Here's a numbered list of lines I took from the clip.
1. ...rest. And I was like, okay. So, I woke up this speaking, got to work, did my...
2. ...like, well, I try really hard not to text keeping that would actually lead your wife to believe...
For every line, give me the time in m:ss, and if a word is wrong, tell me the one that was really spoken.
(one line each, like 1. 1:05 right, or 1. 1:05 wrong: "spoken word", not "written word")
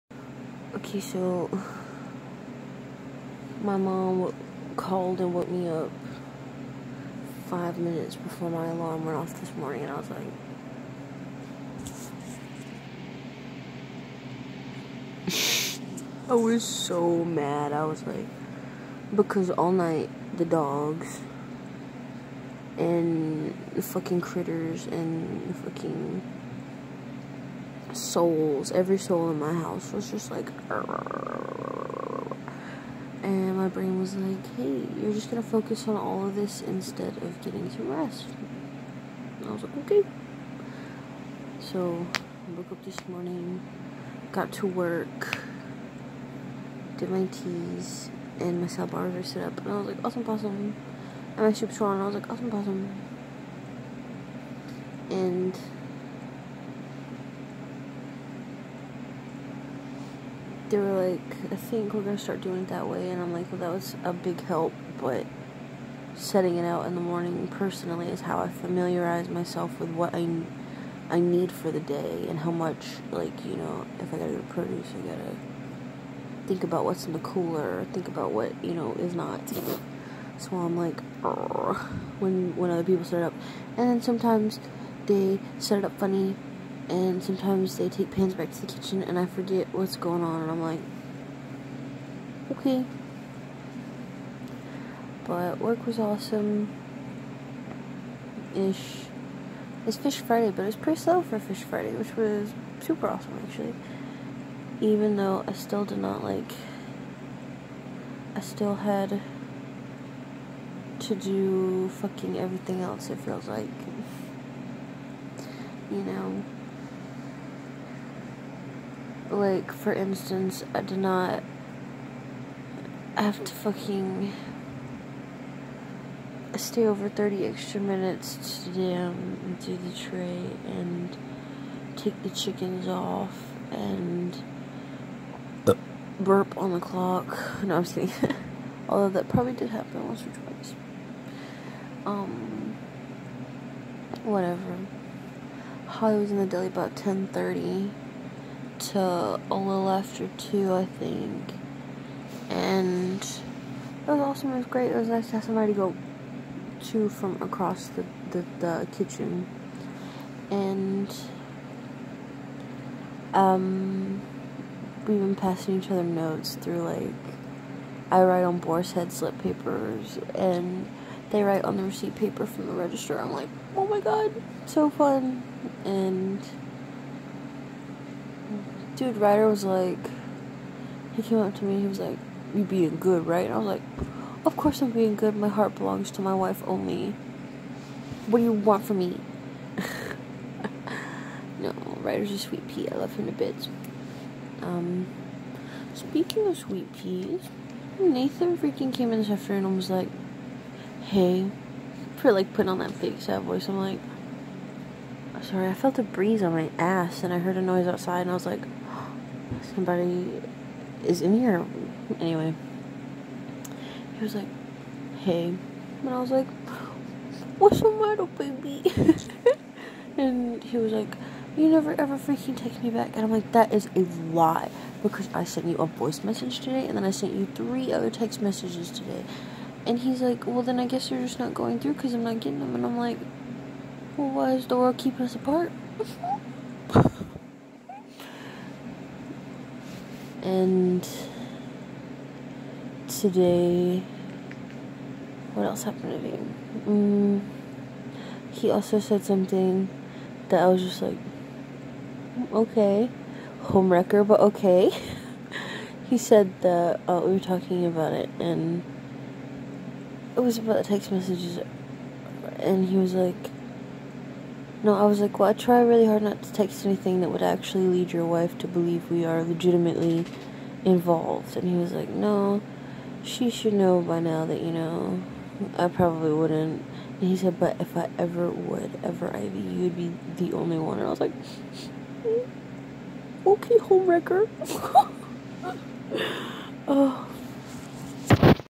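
1. 0:37 wrong: "morning", not "speaking"
2. 4:25 wrong: "anything", not "keeping".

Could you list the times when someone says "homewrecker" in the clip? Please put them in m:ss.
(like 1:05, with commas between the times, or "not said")
4:13, 4:43.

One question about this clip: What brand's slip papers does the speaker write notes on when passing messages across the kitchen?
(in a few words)
Boar's Head.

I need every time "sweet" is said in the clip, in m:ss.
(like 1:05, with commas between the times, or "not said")
3:12, 3:16.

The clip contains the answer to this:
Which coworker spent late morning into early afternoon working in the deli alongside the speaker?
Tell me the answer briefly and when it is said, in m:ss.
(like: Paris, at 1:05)
Holly, at 2:25.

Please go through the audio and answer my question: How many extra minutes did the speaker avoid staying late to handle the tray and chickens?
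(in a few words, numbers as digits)
30.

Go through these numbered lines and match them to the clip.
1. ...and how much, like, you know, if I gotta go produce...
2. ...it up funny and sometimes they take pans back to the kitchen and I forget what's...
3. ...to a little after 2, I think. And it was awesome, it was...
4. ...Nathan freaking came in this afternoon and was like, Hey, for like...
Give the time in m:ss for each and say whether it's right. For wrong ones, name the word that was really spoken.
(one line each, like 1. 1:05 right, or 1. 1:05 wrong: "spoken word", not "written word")
1. 1:12 right
2. 1:25 right
3. 2:28 right
4. 3:17 right.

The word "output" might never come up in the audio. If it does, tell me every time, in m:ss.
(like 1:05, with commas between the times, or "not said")
not said.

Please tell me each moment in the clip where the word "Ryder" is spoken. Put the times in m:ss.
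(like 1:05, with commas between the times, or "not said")
2:59, 3:12.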